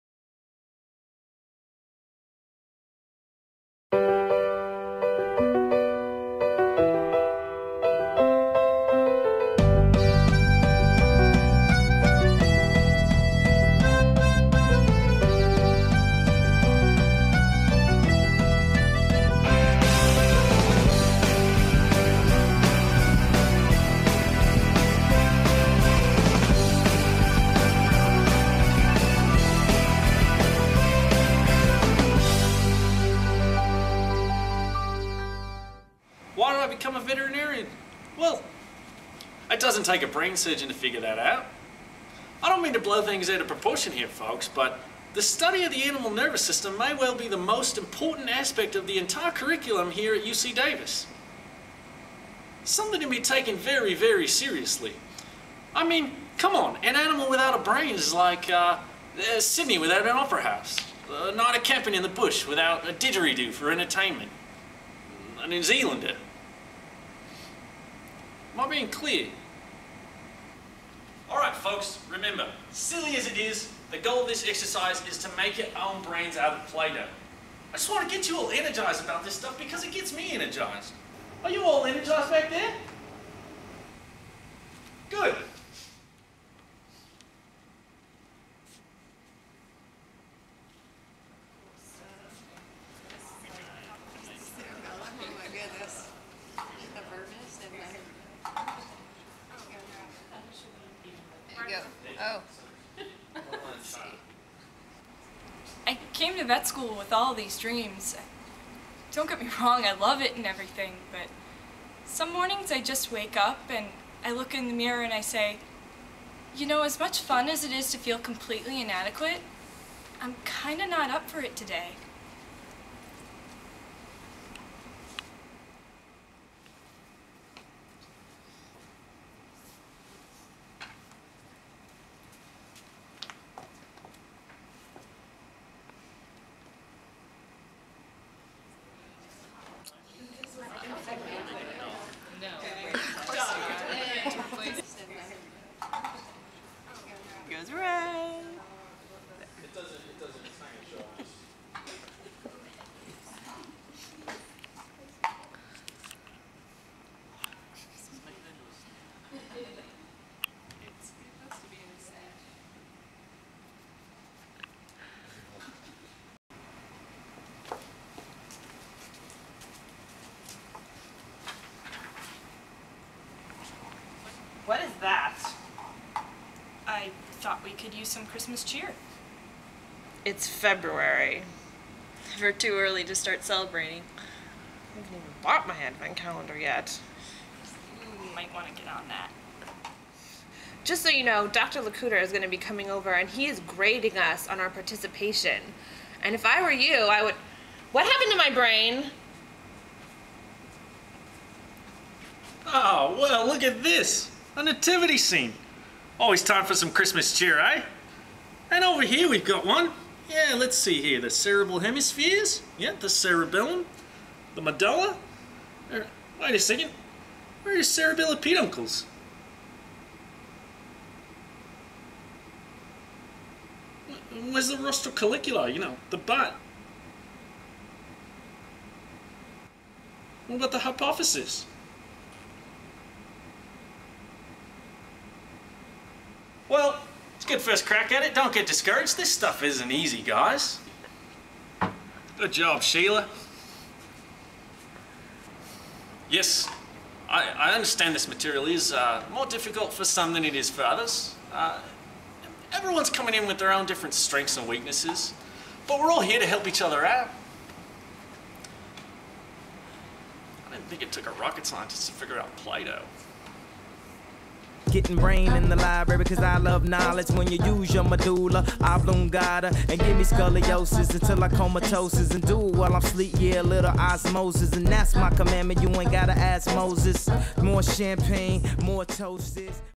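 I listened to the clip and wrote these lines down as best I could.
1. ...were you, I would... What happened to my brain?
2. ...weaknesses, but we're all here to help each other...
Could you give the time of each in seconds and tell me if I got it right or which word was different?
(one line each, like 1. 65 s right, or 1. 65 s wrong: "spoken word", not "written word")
1. 196 s right
2. 254 s right.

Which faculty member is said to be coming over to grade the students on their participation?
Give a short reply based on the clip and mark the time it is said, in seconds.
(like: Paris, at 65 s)
Dr. LeCouteur, at 191 s.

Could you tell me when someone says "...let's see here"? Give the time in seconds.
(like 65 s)
210 s.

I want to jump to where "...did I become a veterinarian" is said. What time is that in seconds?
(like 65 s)
36 s.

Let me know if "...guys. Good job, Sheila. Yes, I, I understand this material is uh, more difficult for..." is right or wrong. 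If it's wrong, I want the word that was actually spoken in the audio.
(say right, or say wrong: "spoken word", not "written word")
right.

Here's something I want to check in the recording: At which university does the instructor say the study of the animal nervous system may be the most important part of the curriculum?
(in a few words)
UC Davis.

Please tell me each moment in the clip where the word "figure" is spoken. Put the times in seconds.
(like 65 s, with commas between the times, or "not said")
40 s, 262 s.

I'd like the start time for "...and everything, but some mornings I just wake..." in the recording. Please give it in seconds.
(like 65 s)
110 s.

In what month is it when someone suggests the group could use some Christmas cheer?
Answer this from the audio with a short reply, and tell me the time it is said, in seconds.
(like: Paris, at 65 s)
February, at 180 s.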